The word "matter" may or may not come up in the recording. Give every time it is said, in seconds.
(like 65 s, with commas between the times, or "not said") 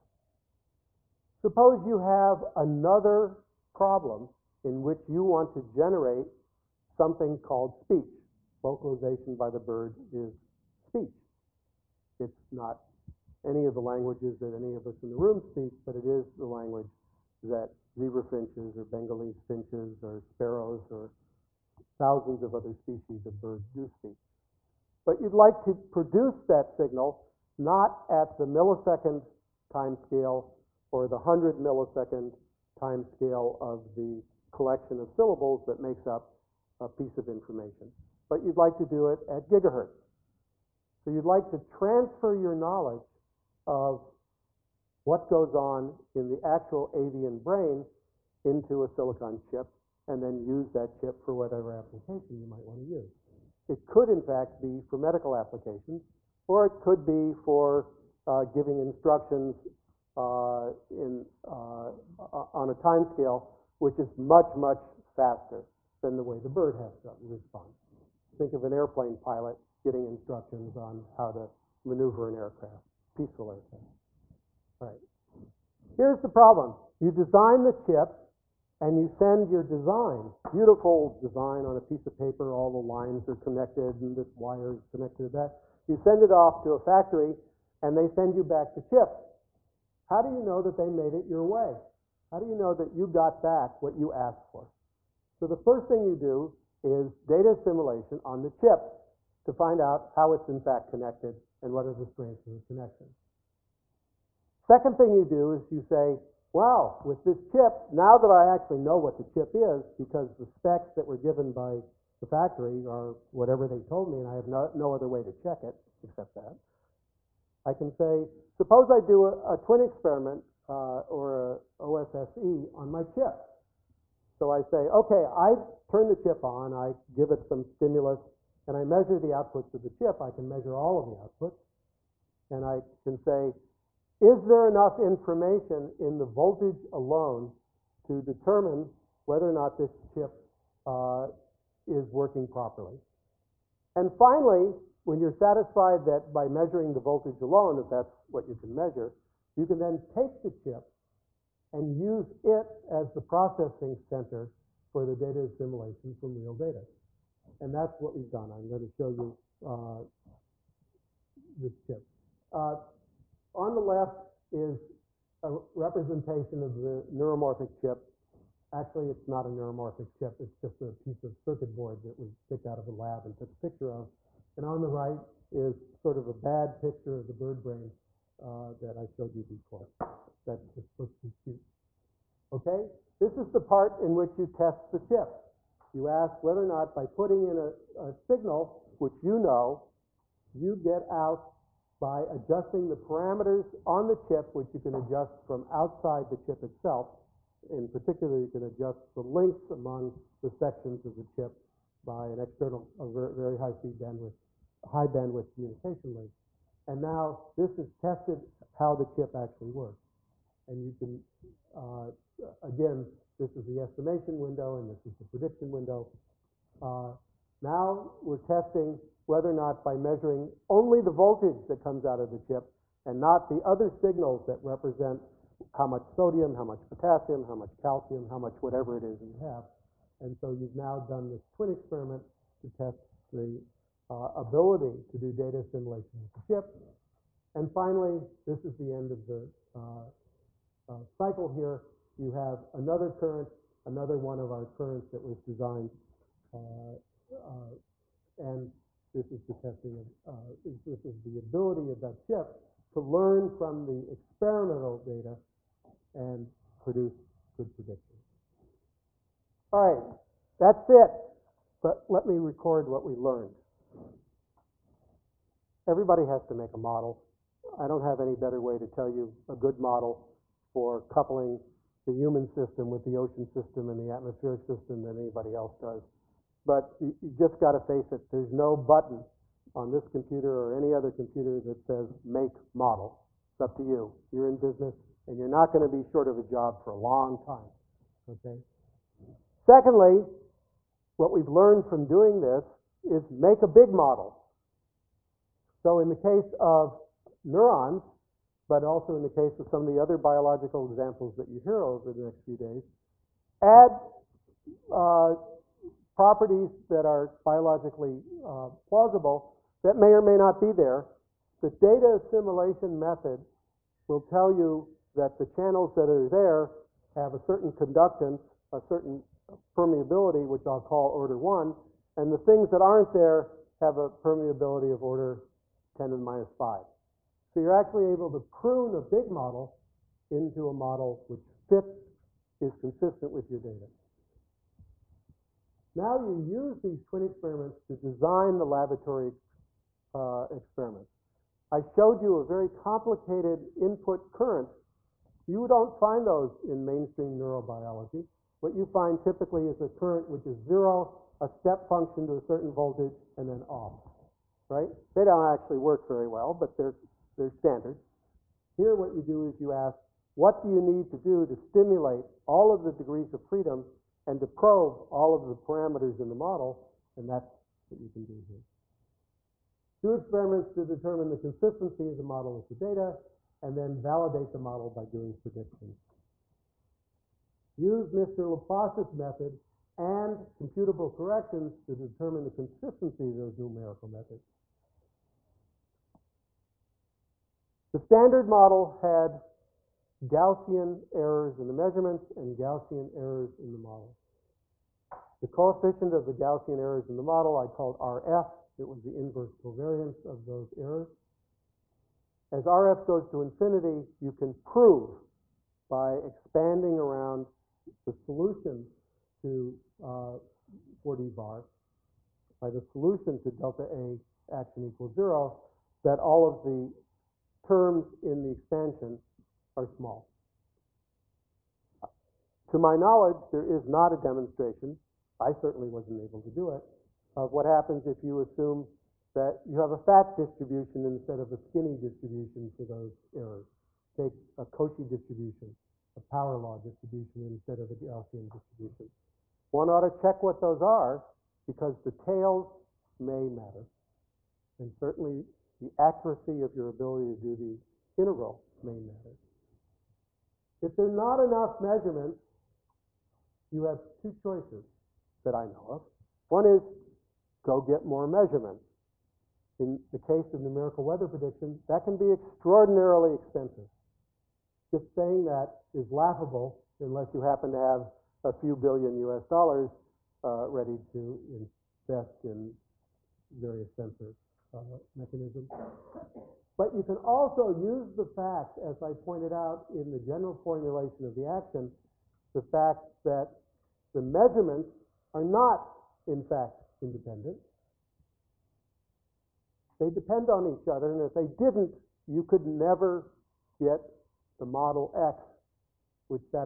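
443 s, 449 s.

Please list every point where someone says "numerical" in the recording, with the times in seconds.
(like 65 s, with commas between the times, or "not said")
383 s, 460 s.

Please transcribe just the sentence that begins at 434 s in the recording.
Take a Cauchy distribution, a power law distribution instead of a Gaussian distribution.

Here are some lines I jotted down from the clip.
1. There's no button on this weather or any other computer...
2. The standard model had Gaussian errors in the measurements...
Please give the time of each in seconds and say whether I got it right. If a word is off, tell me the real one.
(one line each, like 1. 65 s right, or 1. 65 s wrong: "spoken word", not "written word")
1. 278 s wrong: "computer", not "weather"
2. 387 s right.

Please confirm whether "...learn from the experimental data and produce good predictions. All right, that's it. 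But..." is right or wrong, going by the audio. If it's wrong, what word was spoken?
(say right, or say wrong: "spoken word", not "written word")
right.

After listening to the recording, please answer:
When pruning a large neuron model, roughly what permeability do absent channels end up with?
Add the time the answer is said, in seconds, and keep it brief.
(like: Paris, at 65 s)
10 to the minus 5, at 325 s.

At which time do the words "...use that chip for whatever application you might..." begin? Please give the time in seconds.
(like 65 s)
50 s.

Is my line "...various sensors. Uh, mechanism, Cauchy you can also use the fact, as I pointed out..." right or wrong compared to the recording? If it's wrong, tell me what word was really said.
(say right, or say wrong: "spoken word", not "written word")
wrong: "But", not "Cauchy".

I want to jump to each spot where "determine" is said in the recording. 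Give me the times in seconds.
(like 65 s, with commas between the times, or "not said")
138 s, 370 s, 381 s.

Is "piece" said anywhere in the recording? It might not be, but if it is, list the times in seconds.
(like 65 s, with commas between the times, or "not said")
36 s, 81 s, 170 s.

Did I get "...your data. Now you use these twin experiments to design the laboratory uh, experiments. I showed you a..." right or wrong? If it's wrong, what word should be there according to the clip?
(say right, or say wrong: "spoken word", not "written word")
right.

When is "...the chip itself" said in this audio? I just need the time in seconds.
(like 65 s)
196 s.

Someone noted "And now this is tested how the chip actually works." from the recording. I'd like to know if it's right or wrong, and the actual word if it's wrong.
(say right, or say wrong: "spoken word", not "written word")
right.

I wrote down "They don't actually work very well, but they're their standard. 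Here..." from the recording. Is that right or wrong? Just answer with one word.
right.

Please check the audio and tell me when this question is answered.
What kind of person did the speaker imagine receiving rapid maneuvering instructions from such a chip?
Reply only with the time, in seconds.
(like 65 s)
68 s.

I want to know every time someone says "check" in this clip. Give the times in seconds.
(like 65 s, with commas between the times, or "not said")
115 s, 440 s.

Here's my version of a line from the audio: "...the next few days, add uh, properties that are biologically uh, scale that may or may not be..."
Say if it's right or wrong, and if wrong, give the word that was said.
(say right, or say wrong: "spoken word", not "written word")
wrong: "plausible", not "scale".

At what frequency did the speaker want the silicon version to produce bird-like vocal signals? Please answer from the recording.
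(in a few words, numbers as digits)
gigahertz.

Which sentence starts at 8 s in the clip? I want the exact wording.
Vocalization by the bird is speech.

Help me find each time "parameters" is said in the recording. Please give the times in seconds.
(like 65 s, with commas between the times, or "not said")
192 s, 365 s.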